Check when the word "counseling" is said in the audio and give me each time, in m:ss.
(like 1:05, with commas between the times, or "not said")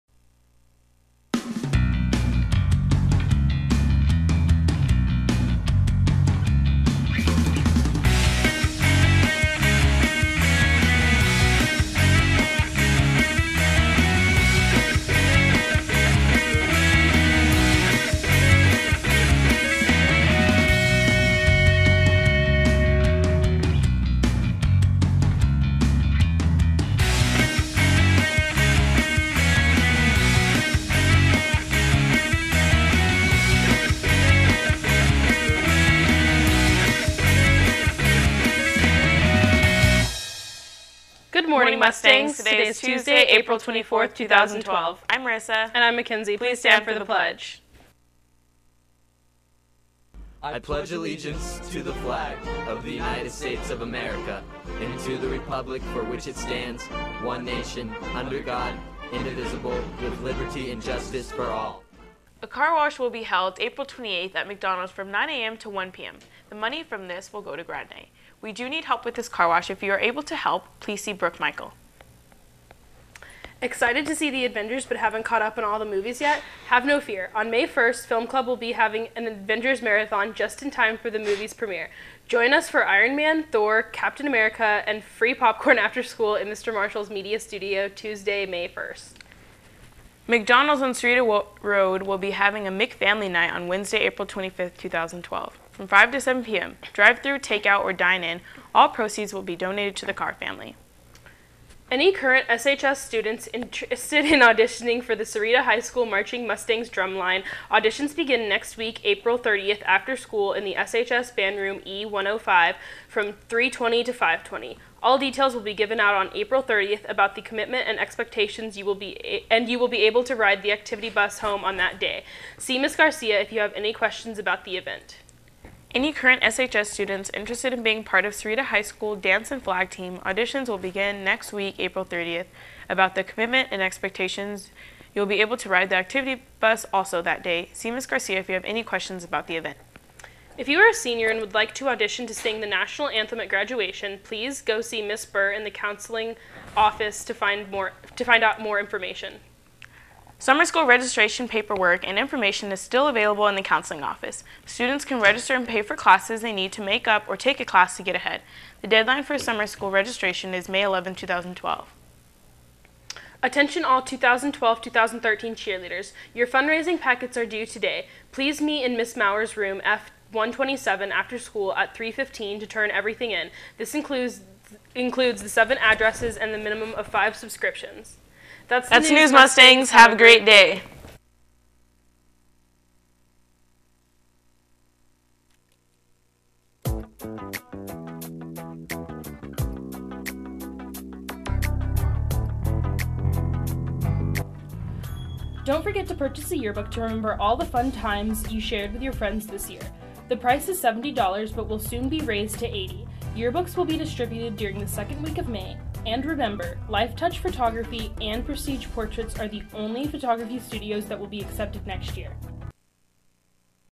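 2:25, 2:33.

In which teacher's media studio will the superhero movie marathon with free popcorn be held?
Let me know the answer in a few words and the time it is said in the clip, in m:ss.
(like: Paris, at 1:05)
Mr. Marshall's, at 1:26.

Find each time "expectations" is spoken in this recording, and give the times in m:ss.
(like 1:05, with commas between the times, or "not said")
1:57, 2:13.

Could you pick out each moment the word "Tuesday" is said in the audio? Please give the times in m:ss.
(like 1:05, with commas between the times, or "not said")
0:42, 1:27.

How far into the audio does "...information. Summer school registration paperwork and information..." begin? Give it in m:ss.
2:28.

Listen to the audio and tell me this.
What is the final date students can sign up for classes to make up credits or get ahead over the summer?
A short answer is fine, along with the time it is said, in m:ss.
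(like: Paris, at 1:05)
May 11, 2012, at 2:40.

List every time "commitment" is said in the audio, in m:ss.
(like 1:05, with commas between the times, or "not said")
1:57, 2:13.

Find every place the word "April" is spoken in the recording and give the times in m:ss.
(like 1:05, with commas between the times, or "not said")
0:43, 1:03, 1:34, 1:49, 1:56, 2:11.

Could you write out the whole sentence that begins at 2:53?
This includes includes the seven addresses and the minimum of 5 subscriptions.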